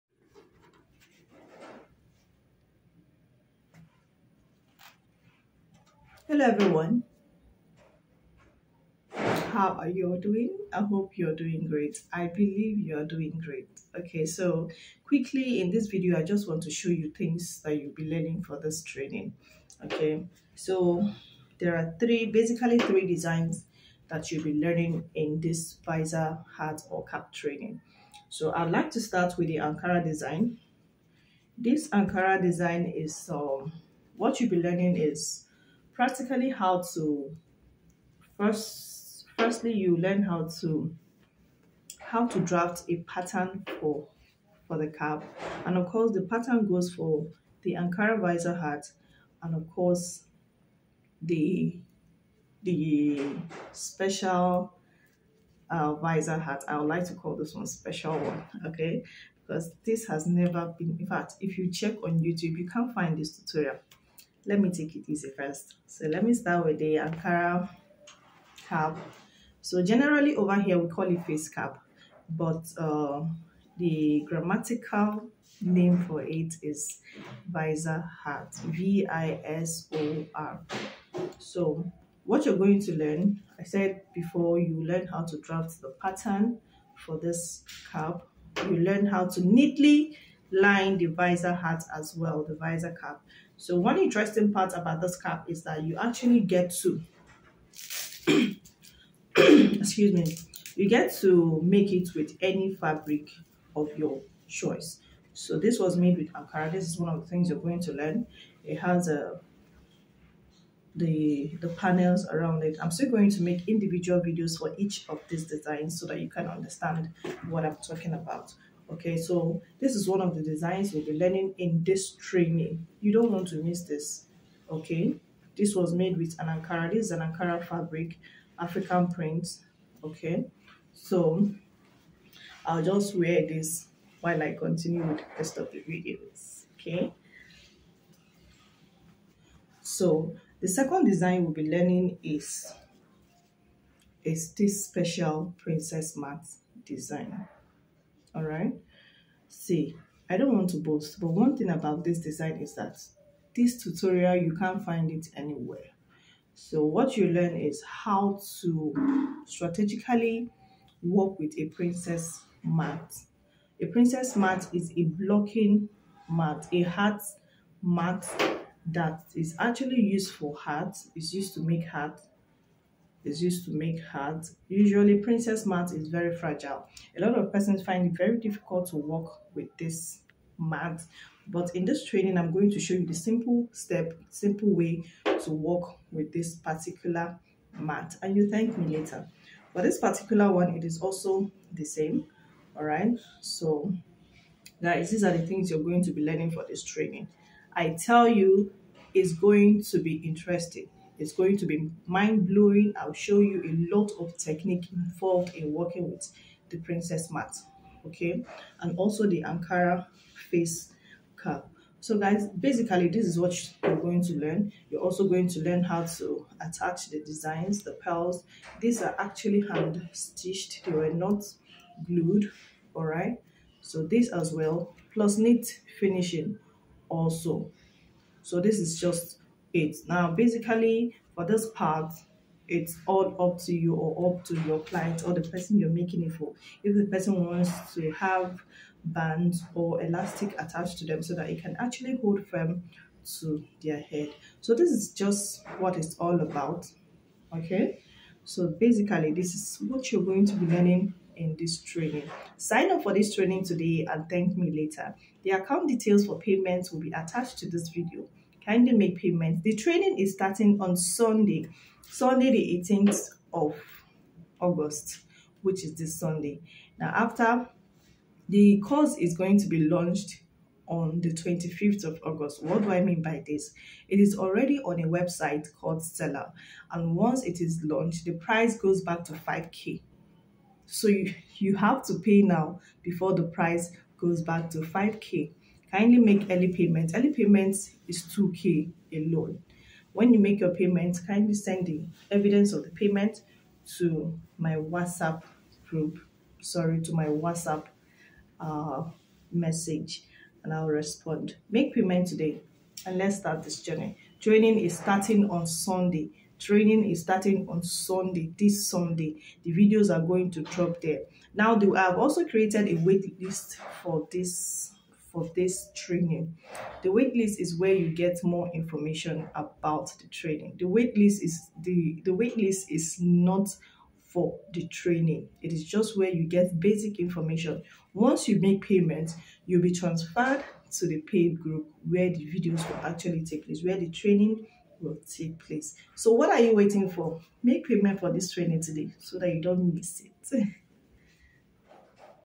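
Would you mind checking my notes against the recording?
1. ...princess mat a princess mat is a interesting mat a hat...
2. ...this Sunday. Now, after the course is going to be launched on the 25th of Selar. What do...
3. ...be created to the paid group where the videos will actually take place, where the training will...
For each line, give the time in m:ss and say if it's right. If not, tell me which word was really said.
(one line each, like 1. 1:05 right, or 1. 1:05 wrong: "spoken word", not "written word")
1. 2:41 wrong: "blocking", not "interesting"
2. 4:25 wrong: "August", not "Selar"
3. 5:29 wrong: "transferred", not "created".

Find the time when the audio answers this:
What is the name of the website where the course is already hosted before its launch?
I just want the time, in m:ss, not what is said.
4:35.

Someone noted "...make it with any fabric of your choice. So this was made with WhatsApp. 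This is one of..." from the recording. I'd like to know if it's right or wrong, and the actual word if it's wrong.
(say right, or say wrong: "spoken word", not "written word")
wrong: "Ankara", not "WhatsApp".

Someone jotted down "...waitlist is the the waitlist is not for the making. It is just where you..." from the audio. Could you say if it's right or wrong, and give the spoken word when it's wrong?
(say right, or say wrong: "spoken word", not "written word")
wrong: "training", not "making".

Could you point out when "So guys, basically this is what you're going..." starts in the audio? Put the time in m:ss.
3:31.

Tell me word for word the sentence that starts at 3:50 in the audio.
Now, basically, for this part, it's all up to you or up to your client or the person you're making it for.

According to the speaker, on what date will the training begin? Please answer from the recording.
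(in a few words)
Sunday 18th of August.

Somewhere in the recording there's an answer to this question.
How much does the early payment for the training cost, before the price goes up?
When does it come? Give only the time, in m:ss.
4:48.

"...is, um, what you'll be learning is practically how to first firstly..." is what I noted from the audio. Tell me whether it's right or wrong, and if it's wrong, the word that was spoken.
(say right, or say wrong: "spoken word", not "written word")
right.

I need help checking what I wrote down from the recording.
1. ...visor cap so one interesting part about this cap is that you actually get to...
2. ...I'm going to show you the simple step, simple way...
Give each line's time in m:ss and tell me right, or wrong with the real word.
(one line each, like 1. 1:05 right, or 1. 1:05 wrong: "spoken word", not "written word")
1. 1:32 right
2. 3:02 right.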